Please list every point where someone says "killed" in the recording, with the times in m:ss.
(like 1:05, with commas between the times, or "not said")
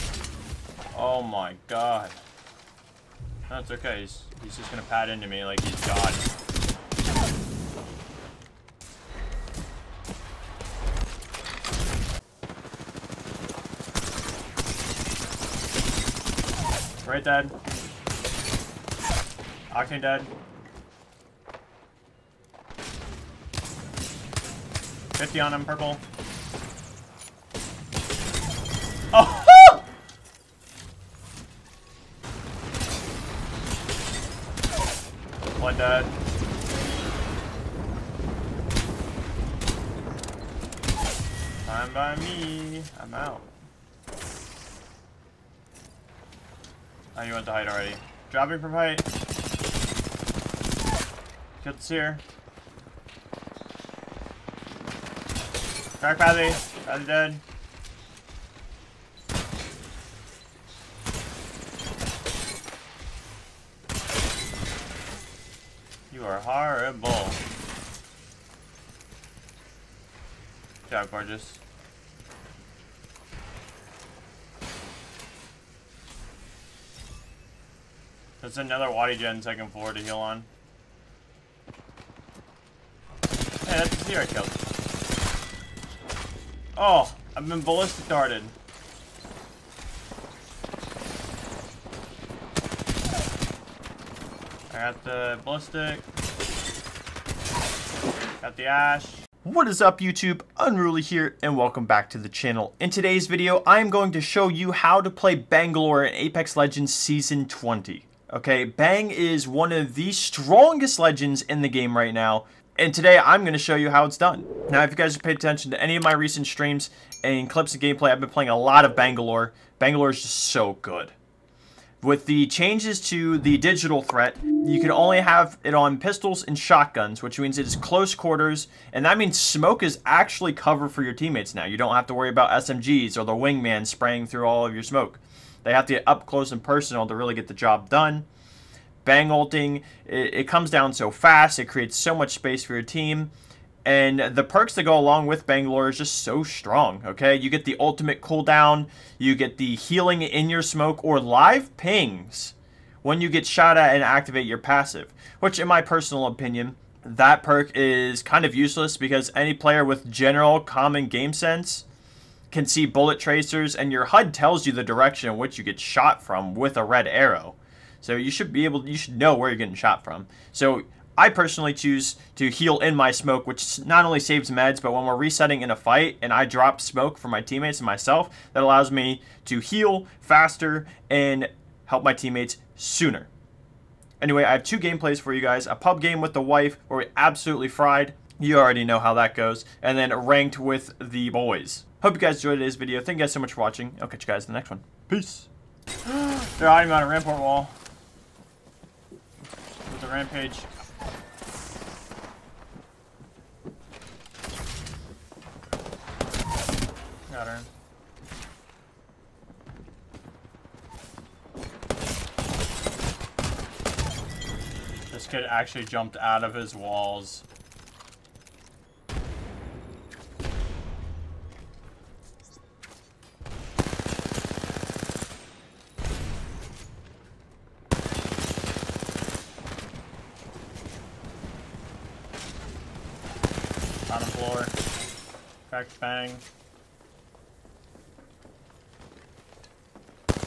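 1:24.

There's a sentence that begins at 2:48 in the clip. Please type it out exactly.
So you should be able, you should know where you're getting shot from.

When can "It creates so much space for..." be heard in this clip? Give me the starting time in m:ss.
2:21.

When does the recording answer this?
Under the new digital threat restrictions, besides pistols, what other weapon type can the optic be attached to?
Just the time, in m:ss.
2:06.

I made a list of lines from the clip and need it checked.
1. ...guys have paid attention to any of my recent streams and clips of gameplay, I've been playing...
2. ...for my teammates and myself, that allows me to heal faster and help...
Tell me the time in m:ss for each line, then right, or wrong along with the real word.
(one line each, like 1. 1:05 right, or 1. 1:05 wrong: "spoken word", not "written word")
1. 1:54 right
2. 2:57 right.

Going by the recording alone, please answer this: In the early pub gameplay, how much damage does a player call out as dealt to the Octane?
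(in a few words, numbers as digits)
50.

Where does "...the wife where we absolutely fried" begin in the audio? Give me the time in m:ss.
3:06.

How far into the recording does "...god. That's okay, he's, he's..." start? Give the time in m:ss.
0:01.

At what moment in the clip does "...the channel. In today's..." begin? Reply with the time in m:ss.
1:42.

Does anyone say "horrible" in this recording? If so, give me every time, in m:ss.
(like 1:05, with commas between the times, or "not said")
1:06.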